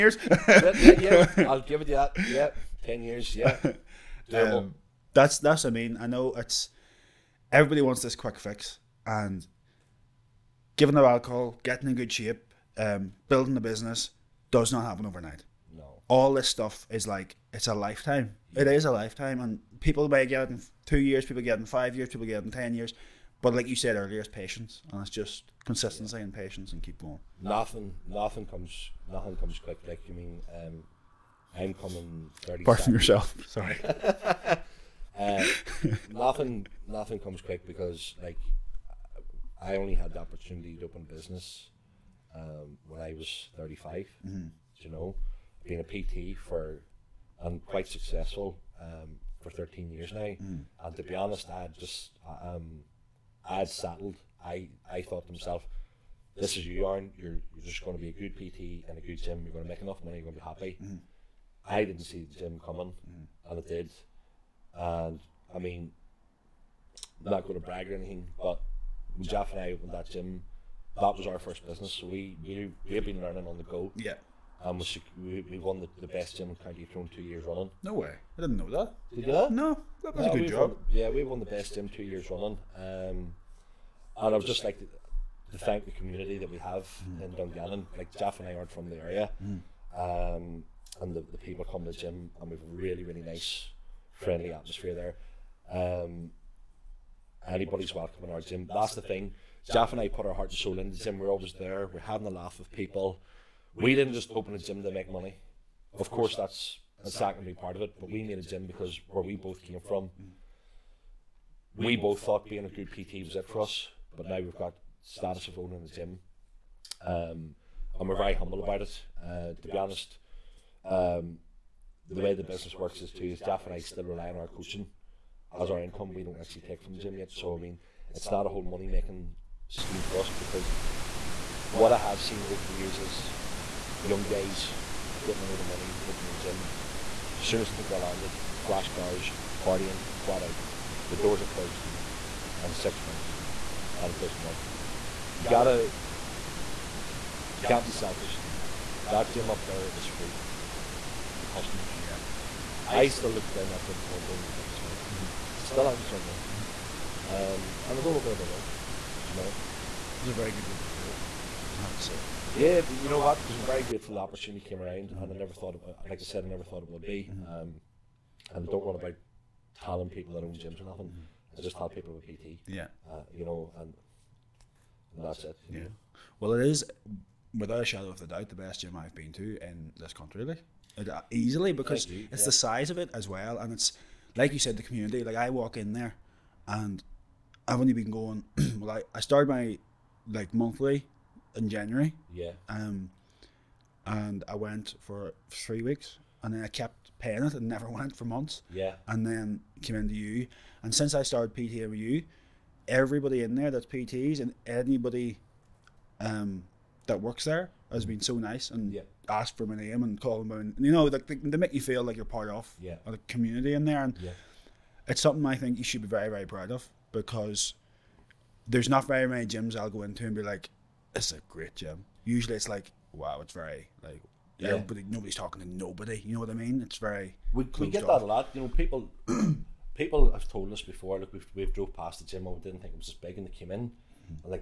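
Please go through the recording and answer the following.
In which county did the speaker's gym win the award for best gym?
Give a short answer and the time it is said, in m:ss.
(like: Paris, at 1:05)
County Tyrone, at 1:16.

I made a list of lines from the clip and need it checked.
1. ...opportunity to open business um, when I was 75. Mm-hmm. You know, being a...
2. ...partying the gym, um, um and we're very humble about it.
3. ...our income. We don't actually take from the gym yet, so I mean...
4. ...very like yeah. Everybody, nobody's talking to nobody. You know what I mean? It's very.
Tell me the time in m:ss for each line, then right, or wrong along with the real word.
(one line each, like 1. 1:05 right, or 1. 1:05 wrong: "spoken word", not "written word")
1. 0:40 wrong: "35", not "75"
2. 1:55 wrong: "owning", not "partying"
3. 2:05 right
4. 3:43 right.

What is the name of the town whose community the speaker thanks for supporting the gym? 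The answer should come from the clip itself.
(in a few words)
Dungannon.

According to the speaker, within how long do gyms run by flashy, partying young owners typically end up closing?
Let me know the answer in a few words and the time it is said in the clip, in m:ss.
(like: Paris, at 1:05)
6 months, at 2:22.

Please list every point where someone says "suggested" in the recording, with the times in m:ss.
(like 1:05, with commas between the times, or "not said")
not said.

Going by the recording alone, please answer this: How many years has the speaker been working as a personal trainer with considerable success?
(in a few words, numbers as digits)
13.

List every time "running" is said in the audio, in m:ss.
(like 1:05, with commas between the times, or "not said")
1:17, 1:22.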